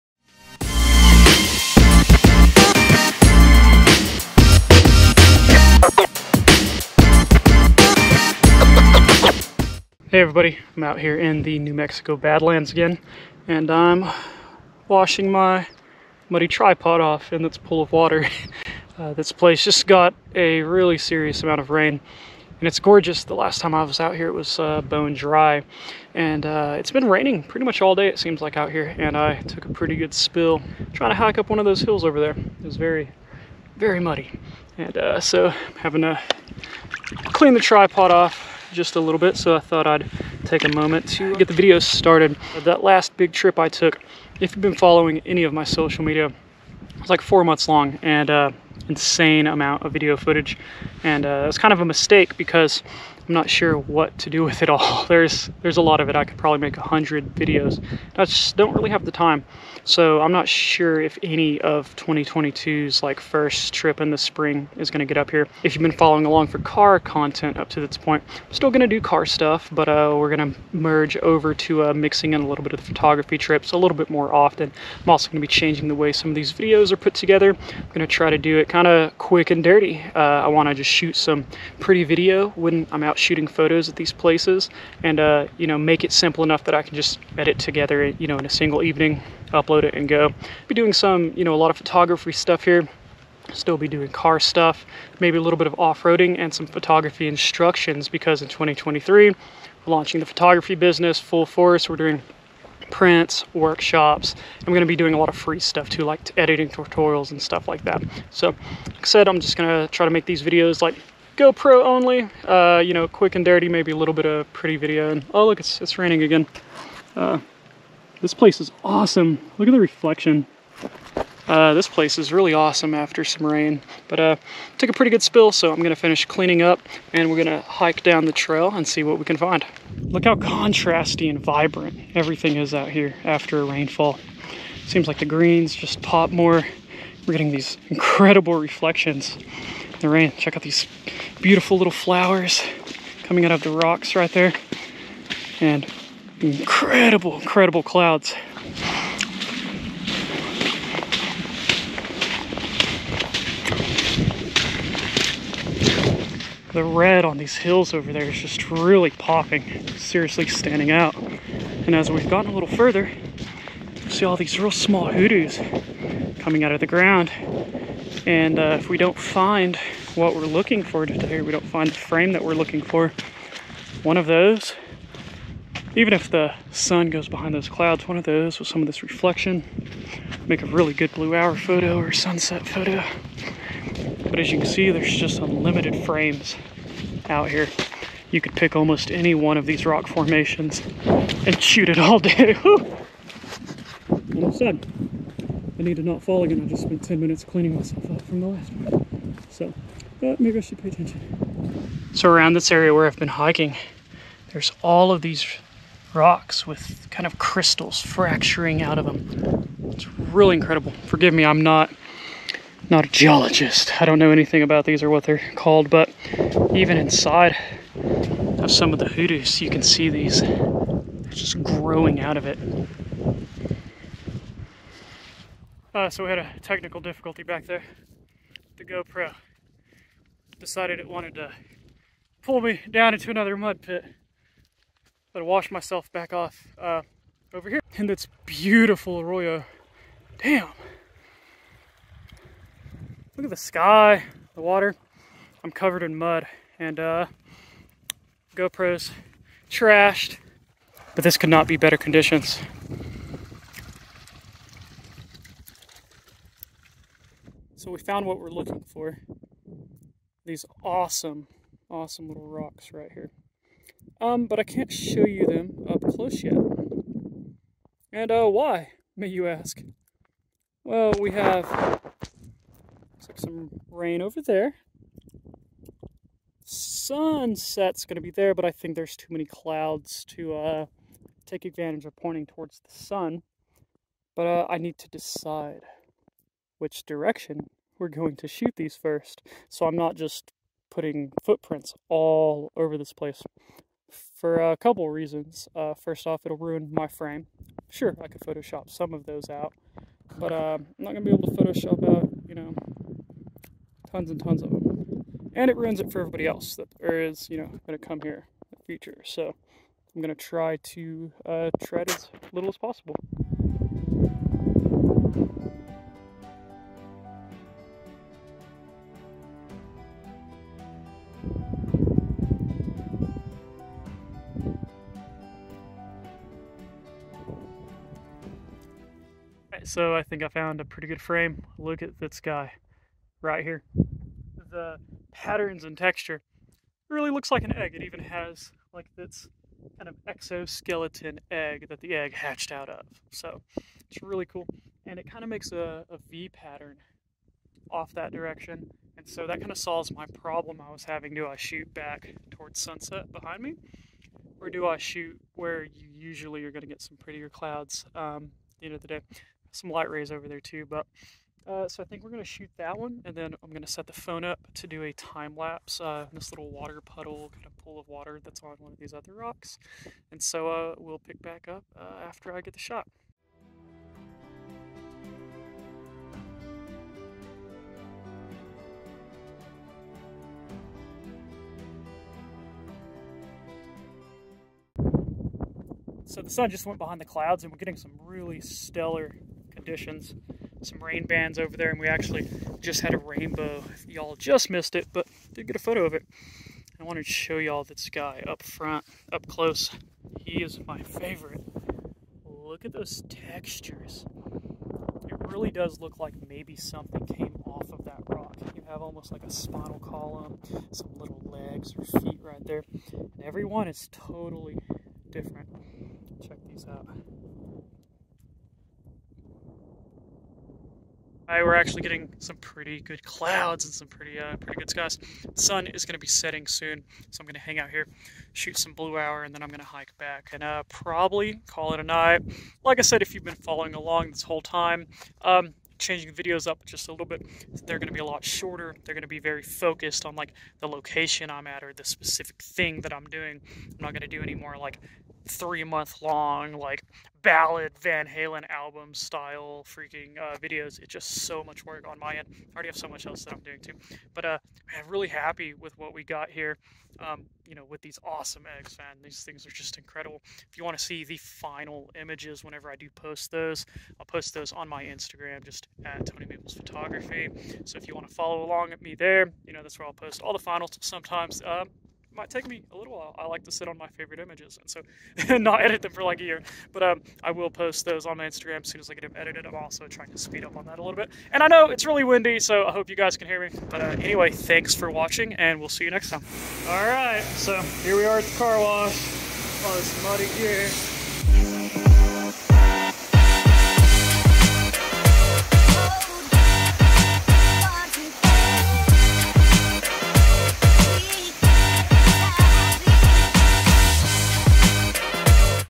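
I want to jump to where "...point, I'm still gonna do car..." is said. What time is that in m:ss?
1:07.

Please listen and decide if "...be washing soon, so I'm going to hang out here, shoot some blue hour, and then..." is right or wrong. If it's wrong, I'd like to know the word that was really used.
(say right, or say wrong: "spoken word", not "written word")
wrong: "setting", not "washing".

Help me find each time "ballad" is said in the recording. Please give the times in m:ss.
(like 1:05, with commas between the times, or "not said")
7:27.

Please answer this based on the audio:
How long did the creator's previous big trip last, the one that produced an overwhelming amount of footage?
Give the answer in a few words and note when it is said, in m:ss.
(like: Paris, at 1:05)
4 months, at 0:47.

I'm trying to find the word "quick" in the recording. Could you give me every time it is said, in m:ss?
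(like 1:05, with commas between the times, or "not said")
1:19, 1:53.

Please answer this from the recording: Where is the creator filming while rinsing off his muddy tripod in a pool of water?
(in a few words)
New Mexico Badlands.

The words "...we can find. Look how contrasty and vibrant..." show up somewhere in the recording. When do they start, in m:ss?
2:09.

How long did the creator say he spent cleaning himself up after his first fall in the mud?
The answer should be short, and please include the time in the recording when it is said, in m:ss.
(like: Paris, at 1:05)
10 minutes, at 3:17.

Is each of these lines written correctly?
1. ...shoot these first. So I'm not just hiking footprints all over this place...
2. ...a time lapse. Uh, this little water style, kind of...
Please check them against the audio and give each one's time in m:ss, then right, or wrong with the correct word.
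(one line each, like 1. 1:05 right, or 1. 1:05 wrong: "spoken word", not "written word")
1. 4:48 wrong: "putting", not "hiking"
2. 6:05 wrong: "puddle", not "style".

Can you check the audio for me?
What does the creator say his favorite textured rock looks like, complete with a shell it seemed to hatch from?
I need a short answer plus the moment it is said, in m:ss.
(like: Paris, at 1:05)
an egg, at 5:37.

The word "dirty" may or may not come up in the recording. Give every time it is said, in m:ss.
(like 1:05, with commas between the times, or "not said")
1:19, 1:53.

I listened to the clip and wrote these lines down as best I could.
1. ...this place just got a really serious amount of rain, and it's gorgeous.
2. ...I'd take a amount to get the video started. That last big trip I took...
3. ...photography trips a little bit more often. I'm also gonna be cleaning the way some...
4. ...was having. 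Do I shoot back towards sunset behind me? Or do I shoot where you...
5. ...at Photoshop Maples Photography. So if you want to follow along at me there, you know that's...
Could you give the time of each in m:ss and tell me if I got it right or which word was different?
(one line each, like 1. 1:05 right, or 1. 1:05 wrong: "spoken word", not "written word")
1. 0:19 right
2. 0:39 wrong: "moment", not "amount"
3. 1:12 wrong: "changing", not "cleaning"
4. 5:50 right
5. 7:46 wrong: "Tony", not "Photoshop".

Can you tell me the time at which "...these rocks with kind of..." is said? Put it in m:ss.
3:25.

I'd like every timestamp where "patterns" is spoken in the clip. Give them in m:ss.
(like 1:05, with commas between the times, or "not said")
5:35, 5:46.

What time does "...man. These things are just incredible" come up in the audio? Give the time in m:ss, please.
7:38.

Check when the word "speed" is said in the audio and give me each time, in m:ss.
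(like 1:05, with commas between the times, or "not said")
8:00.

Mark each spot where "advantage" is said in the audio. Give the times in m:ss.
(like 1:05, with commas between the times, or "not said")
4:41.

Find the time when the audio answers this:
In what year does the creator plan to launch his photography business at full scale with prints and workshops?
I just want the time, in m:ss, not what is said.
1:38.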